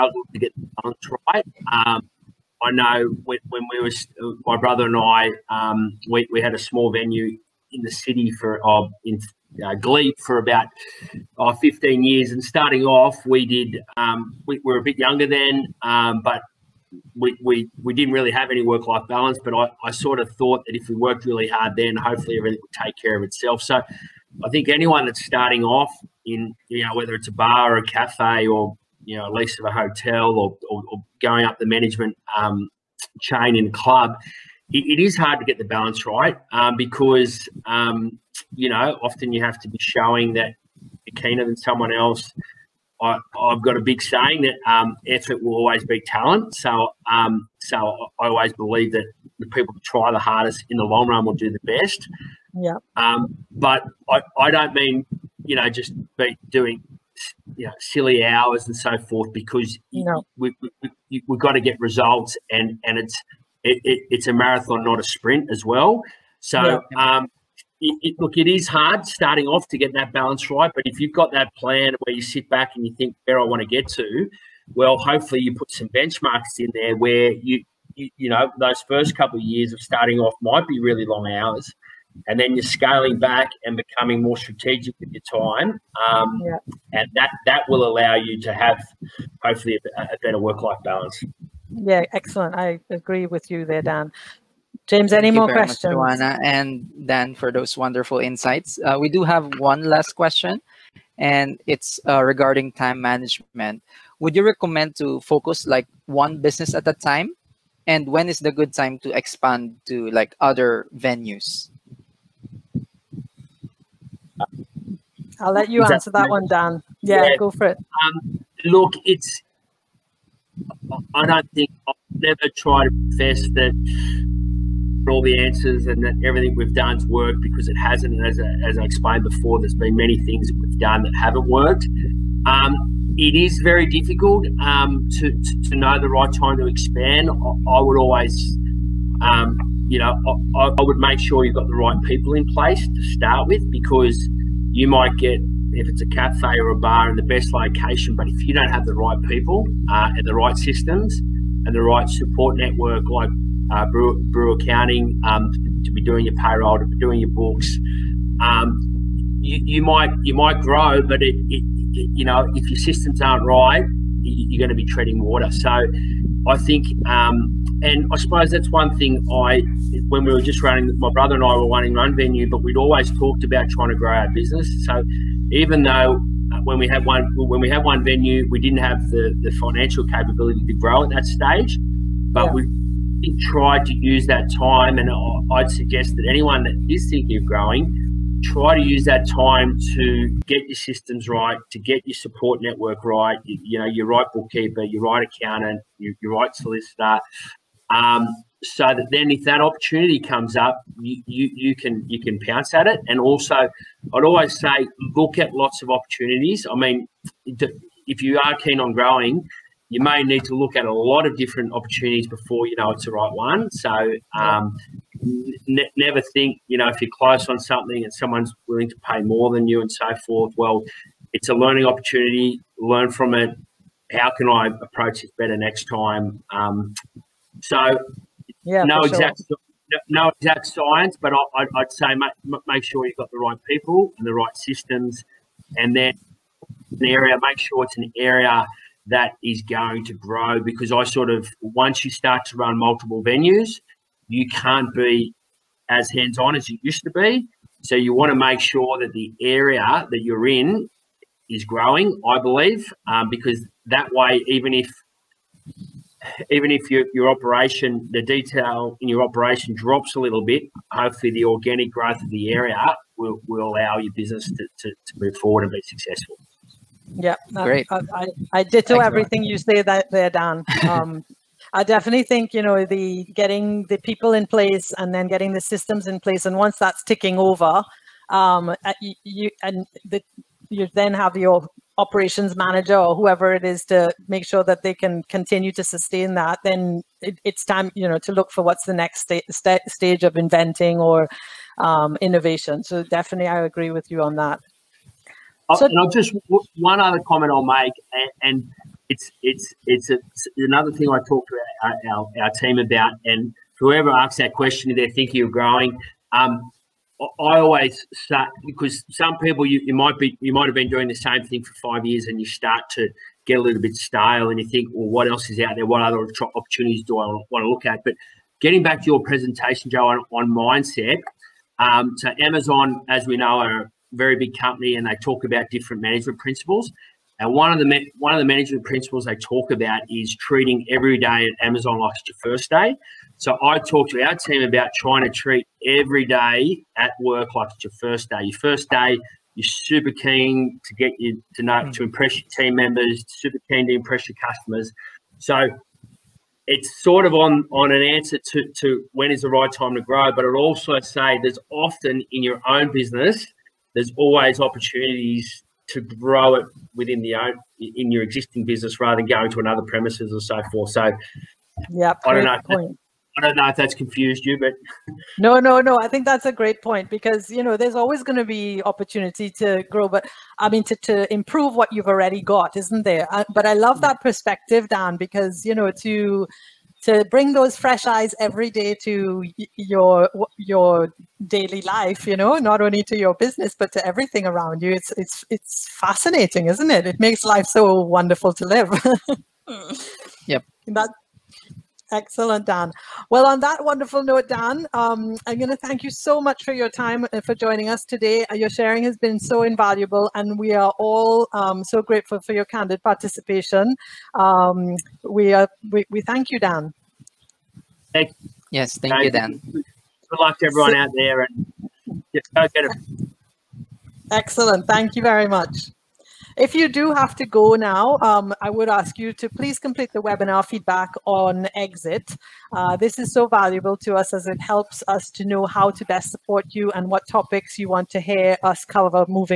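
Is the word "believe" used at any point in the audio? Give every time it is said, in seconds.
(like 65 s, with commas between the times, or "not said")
48 s, 252 s.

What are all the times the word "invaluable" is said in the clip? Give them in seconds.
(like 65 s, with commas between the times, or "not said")
399 s.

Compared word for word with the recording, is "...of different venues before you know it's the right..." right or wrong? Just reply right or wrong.
wrong.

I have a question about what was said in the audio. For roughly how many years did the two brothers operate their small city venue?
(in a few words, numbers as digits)
15 years.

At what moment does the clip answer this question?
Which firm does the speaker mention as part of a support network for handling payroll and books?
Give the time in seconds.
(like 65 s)
154 s.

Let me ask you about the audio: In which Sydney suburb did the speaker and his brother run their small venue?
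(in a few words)
Glebe.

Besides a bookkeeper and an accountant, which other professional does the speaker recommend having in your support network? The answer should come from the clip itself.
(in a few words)
Solicitor.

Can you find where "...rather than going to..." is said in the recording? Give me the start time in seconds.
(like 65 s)
358 s.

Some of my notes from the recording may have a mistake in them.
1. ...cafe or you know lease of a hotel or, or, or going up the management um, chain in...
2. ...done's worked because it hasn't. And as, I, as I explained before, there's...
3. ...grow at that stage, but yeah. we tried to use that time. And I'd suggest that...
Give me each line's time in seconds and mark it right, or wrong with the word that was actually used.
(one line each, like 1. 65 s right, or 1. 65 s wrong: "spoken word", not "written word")
1. 27 s right
2. 126 s right
3. 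180 s right.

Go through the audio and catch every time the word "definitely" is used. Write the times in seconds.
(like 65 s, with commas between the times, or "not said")
271 s, 293 s.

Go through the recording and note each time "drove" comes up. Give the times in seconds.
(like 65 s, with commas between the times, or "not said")
not said.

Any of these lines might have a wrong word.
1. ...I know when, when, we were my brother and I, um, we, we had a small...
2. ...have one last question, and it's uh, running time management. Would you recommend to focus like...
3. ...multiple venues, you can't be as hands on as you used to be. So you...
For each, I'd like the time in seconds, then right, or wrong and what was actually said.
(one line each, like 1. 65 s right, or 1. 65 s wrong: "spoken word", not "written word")
1. 2 s right
2. 99 s wrong: "regarding", not "running"
3. 242 s right.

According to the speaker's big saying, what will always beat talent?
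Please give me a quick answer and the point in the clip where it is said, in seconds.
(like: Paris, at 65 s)
Effort, at 45 s.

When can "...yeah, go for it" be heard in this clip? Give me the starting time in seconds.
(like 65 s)
117 s.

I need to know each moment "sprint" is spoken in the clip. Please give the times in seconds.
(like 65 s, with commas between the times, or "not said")
65 s.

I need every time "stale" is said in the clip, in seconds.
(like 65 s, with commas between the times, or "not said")
313 s.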